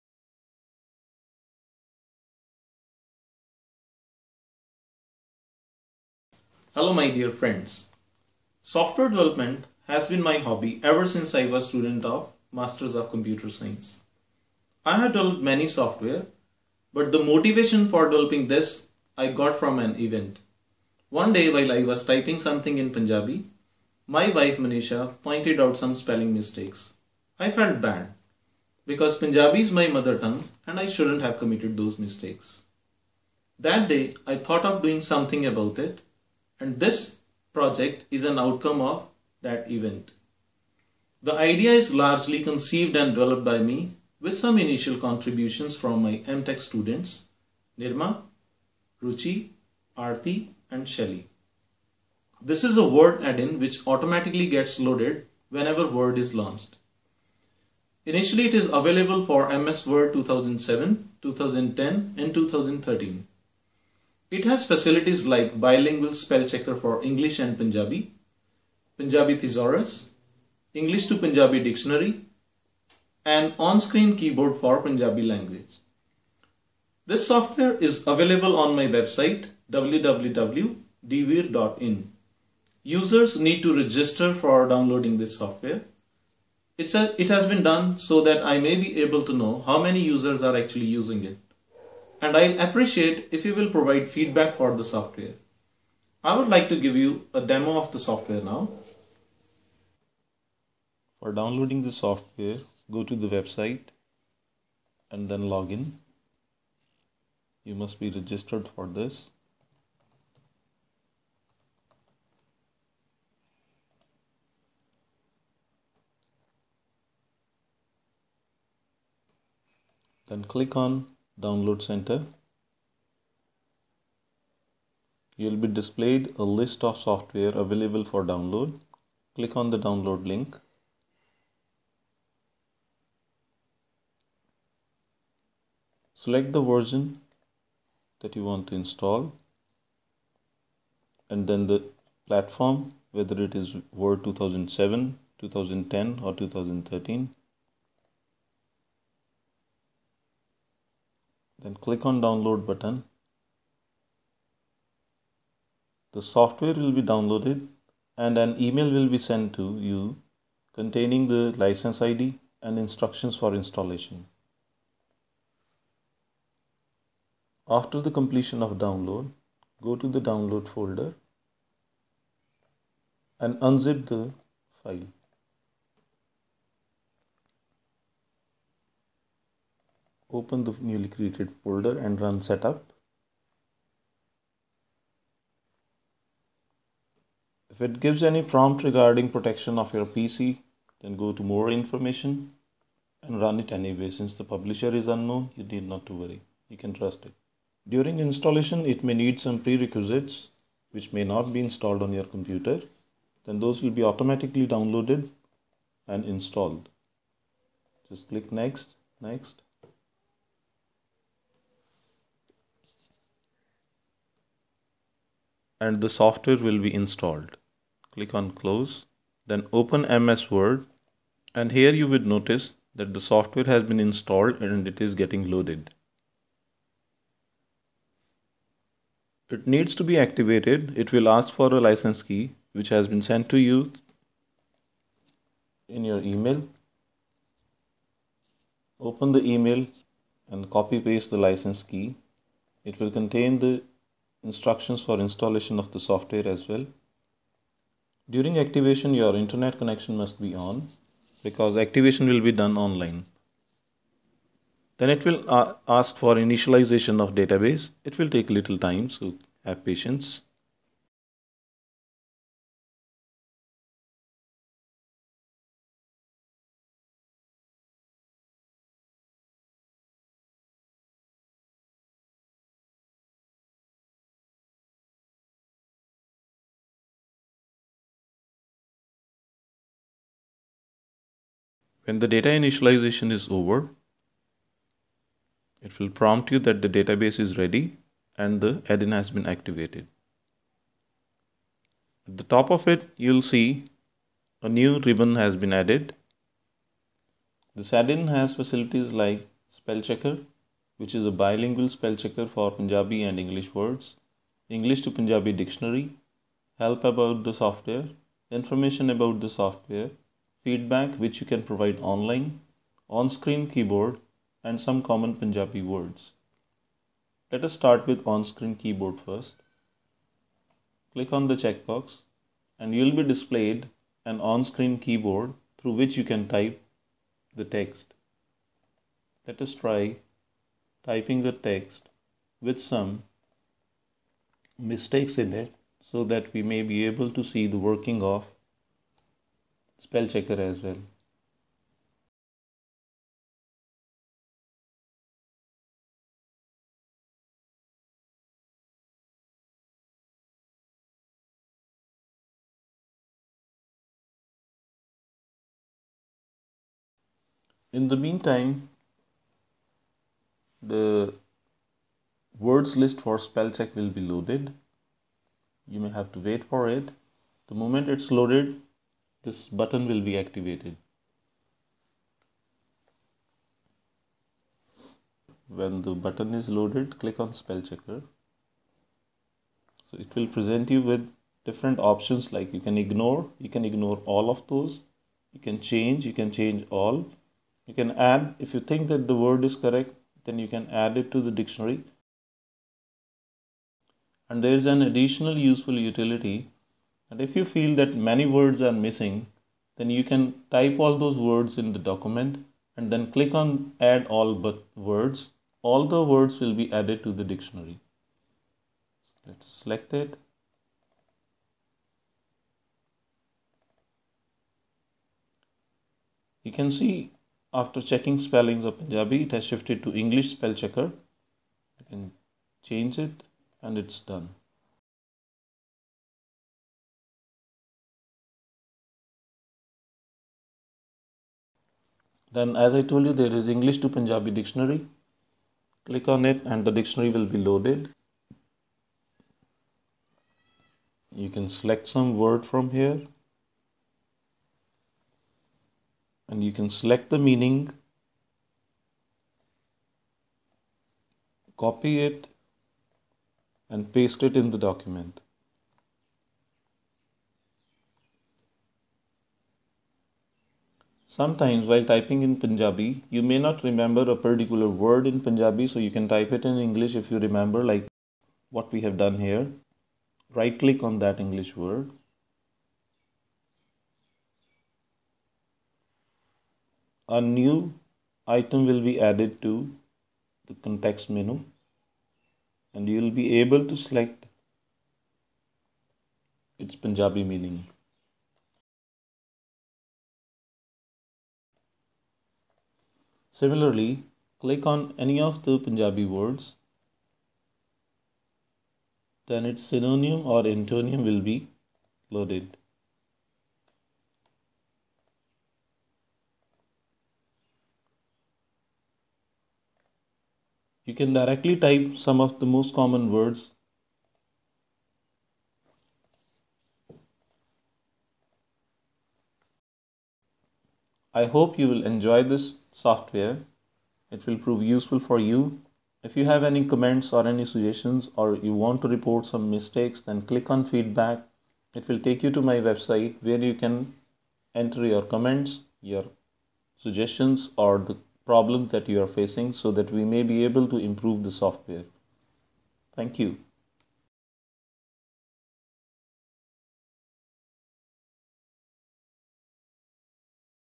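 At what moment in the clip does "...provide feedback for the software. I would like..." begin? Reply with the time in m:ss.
1:33.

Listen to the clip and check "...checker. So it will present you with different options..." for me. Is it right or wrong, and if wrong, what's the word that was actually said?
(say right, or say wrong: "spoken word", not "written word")
right.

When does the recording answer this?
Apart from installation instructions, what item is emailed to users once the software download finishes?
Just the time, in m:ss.
2:41.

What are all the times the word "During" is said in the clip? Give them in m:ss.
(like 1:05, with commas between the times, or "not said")
3:17, 4:08.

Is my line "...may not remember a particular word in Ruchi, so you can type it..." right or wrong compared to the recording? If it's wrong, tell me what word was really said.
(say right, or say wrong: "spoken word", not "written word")
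wrong: "Punjabi", not "Ruchi".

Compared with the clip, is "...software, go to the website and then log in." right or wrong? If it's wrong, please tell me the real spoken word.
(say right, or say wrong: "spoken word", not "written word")
right.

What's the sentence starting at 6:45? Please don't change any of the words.
All the words will be added to the dictionary.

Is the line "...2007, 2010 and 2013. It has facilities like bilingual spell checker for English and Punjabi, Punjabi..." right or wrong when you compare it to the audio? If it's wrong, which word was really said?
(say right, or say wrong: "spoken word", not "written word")
right.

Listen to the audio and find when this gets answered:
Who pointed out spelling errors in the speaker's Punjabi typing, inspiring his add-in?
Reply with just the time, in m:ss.
0:24.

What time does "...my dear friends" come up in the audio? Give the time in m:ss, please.
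0:06.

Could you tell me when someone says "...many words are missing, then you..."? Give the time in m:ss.
6:38.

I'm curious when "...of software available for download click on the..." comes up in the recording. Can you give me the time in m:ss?
2:06.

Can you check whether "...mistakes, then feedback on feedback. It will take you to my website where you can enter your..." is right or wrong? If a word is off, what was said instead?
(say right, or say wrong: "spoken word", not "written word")
wrong: "click", not "feedback".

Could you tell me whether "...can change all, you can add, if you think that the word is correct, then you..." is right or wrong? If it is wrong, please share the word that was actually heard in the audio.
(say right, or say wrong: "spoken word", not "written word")
right.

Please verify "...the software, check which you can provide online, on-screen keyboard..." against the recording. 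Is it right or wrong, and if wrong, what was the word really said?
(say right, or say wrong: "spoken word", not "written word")
wrong: "feedback", not "check".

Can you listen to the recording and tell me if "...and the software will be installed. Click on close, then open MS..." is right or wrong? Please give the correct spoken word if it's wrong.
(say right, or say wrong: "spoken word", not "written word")
right.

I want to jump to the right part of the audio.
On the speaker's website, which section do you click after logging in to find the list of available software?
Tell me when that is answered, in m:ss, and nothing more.
2:01.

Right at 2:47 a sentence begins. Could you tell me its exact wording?
After the completion of download, go to the download folder and unzip the file.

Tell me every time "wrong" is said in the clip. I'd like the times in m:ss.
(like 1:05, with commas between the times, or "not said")
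not said.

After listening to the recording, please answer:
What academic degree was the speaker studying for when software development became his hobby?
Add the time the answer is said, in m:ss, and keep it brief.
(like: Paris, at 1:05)
Masters of Computer Science, at 0:12.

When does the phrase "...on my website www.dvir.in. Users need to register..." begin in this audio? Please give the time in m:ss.
1:18.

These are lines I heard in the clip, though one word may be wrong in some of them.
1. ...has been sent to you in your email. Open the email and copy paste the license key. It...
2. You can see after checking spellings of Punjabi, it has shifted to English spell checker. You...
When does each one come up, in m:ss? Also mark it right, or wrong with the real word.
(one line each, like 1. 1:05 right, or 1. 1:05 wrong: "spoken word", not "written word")
1. 3:52 right
2. 6:56 right.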